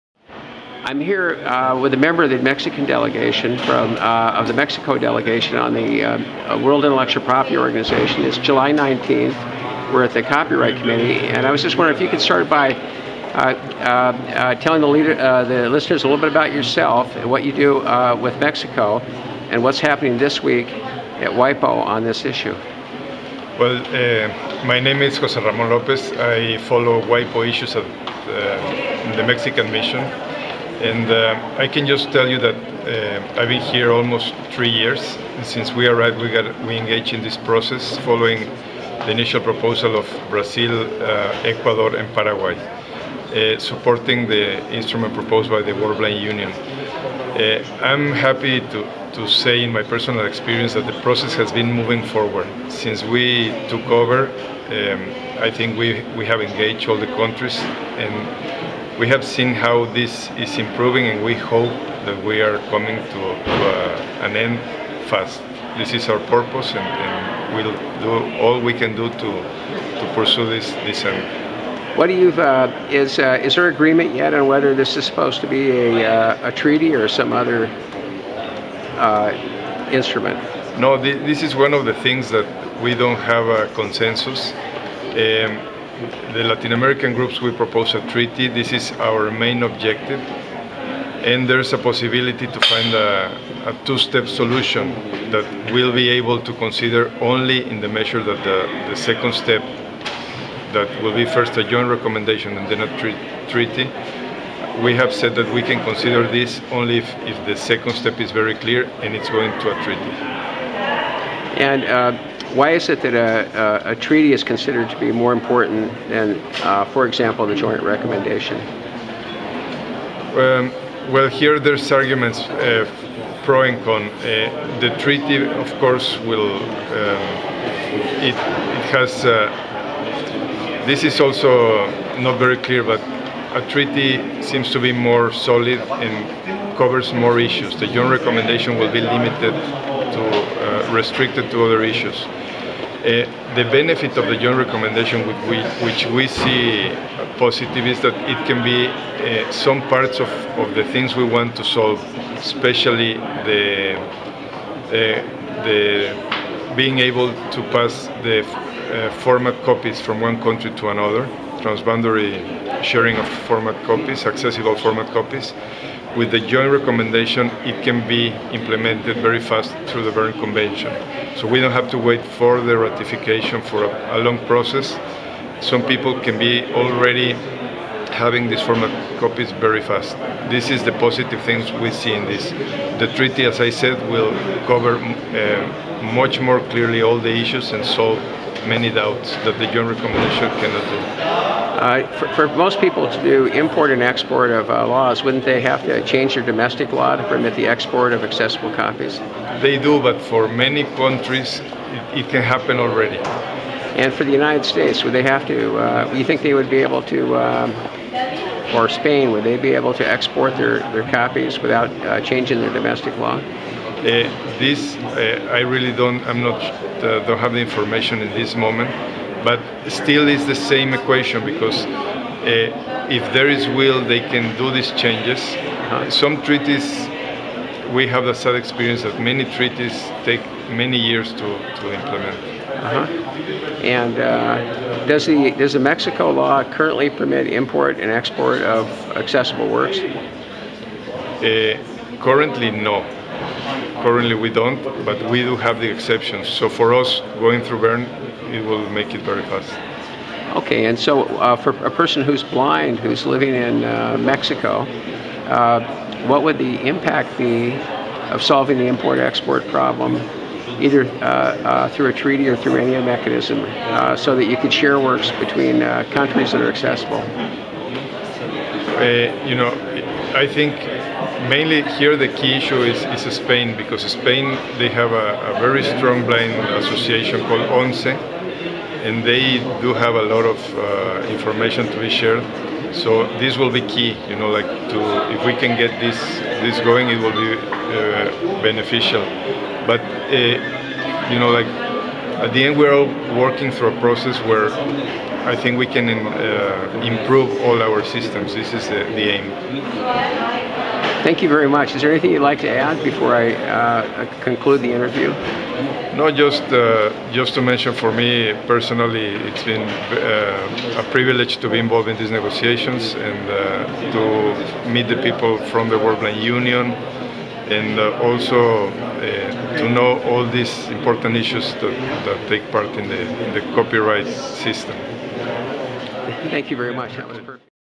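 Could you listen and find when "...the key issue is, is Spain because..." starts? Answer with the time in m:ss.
4:32.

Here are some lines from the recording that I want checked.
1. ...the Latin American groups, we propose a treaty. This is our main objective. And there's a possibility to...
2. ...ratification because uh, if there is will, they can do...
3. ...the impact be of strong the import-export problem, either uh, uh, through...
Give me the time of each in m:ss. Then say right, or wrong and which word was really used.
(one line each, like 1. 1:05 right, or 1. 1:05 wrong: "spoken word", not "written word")
1. 1:26 right
2. 3:40 wrong: "equation", not "ratification"
3. 4:16 wrong: "solving", not "strong".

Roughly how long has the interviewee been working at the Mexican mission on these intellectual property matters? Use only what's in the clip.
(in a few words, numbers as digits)
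almost three years.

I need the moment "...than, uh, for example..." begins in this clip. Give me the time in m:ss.
1:56.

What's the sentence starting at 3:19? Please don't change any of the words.
They do, but for many countries, it, it can happen already.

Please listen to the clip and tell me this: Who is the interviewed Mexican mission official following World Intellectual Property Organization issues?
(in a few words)
Jose Ramon Lopez.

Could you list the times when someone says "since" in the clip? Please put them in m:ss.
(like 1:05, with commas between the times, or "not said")
0:35, 0:52.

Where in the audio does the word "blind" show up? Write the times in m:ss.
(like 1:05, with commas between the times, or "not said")
0:45, 4:12, 4:36, 5:16.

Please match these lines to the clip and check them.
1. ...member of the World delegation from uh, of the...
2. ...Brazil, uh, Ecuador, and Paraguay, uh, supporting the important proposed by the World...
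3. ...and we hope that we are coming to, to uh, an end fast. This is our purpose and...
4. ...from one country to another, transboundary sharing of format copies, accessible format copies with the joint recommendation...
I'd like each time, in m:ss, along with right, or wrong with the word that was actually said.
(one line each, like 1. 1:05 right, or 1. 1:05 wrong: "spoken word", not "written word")
1. 0:01 wrong: "Mexican", not "World"
2. 0:40 wrong: "instrument", not "important"
3. 1:01 right
4. 2:39 right.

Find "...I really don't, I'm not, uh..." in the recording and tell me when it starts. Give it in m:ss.
3:35.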